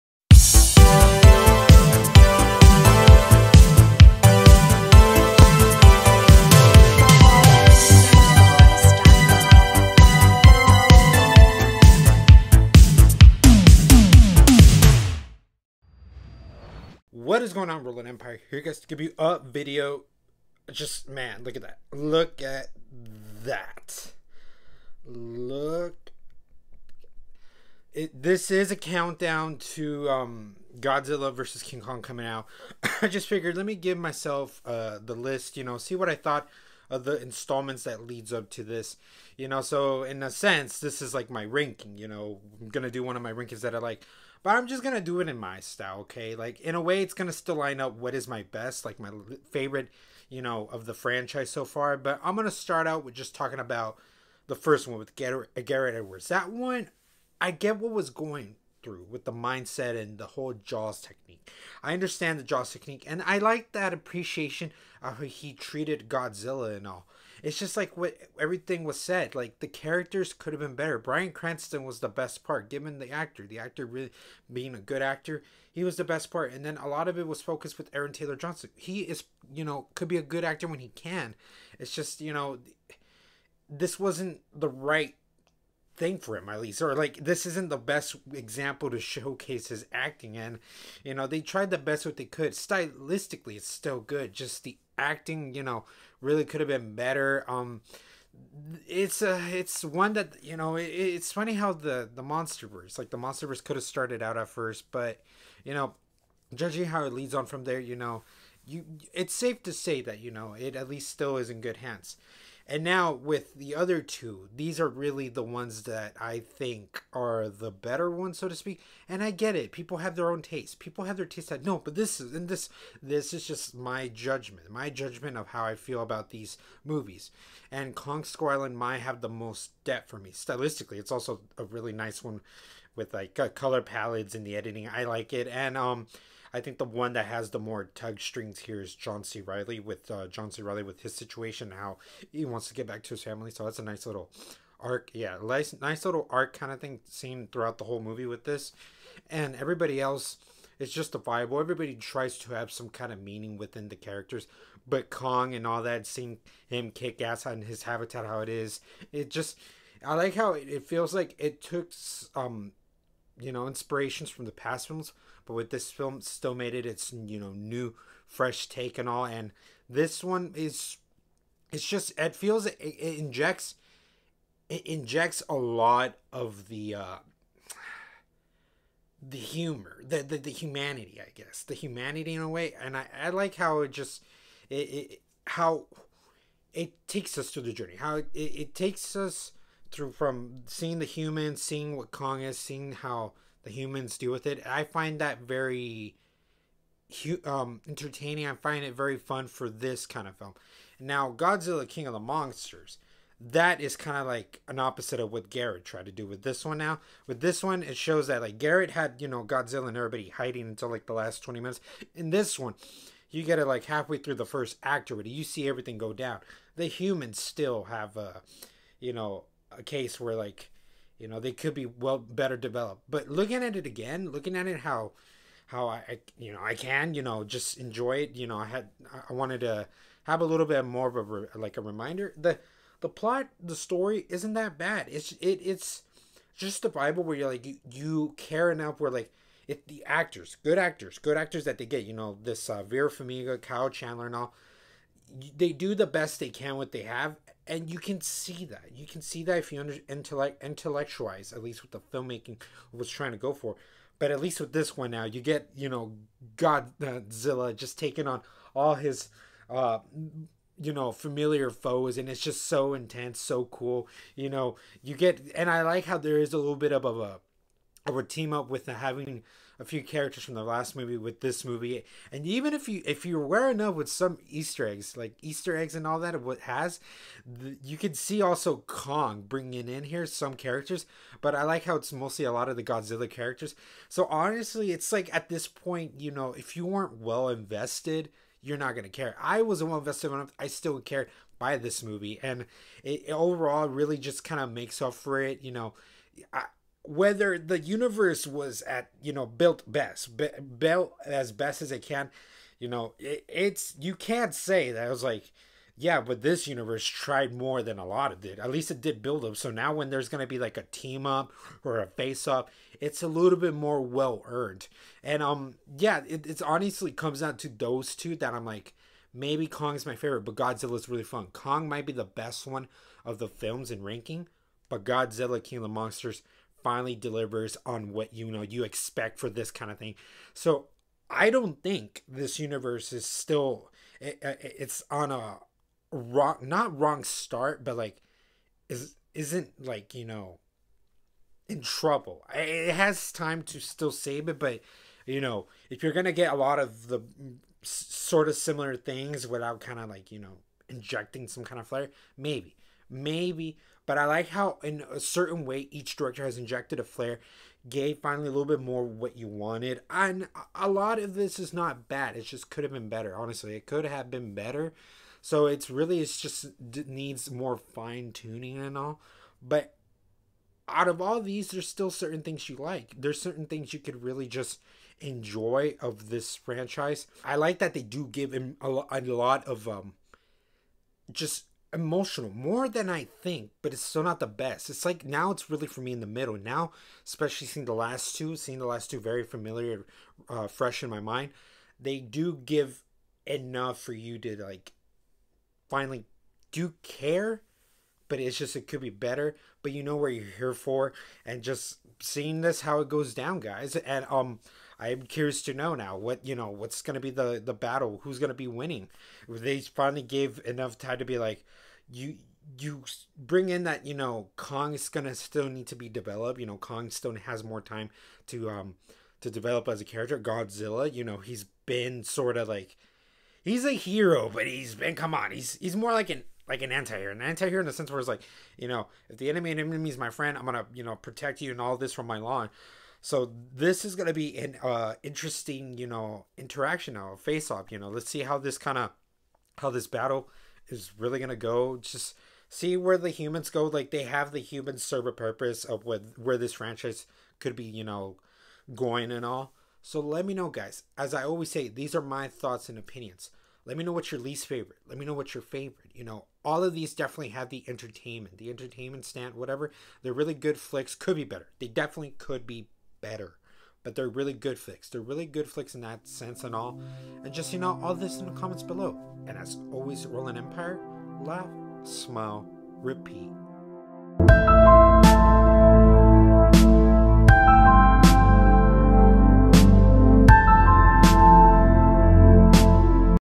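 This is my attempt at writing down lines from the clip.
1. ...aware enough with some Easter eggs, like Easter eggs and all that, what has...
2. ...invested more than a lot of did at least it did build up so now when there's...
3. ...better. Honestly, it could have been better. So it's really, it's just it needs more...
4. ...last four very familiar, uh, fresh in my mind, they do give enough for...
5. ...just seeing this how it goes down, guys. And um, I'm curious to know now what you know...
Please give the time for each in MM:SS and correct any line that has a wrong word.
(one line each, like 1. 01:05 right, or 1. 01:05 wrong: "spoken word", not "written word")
1. 04:33 right
2. 05:07 wrong: "tried", not "invested"
3. 06:03 right
4. 06:28 wrong: "two", not "four"
5. 06:41 right.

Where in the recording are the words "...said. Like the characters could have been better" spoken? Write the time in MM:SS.
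01:08.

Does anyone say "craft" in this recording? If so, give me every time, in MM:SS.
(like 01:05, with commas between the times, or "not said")
not said.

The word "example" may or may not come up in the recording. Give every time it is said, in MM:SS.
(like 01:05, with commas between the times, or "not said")
01:28.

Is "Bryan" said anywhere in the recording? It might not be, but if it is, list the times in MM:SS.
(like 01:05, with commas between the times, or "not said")
01:10.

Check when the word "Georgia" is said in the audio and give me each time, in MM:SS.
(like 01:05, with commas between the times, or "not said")
not said.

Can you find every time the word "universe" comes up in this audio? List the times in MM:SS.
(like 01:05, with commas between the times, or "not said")
04:57, 05:06, 05:32.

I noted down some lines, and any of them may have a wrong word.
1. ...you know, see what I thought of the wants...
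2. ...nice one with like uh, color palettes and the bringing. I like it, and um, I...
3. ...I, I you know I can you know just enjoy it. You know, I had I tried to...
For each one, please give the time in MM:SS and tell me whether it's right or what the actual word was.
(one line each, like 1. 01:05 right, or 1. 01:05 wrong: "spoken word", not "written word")
1. 00:35 wrong: "installments", not "wants"
2. 02:11 wrong: "editing", not "bringing"
3. 03:45 wrong: "wanted", not "tried".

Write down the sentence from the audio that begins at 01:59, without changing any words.
And I get it; people have their own taste.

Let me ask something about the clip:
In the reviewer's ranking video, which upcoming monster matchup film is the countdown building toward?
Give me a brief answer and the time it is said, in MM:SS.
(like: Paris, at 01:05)
Godzilla versus King Kong, at 00:30.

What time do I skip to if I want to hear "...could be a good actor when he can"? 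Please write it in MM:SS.
01:19.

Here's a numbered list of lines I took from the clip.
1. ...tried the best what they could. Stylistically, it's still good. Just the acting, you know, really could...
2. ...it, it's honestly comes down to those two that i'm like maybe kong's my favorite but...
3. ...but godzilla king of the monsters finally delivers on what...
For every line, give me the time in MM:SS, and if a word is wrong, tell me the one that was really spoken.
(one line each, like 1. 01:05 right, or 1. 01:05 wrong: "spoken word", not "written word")
1. 01:31 right
2. 05:16 right
3. 05:24 right.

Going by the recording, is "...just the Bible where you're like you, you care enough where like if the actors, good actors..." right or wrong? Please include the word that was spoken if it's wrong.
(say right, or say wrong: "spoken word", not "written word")
right.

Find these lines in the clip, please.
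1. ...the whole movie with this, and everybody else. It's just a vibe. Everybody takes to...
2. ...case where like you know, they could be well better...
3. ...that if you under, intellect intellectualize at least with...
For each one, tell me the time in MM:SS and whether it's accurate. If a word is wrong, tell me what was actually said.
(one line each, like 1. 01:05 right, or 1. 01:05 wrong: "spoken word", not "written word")
1. 02:27 wrong: "tries", not "takes"
2. 03:39 right
3. 04:09 right.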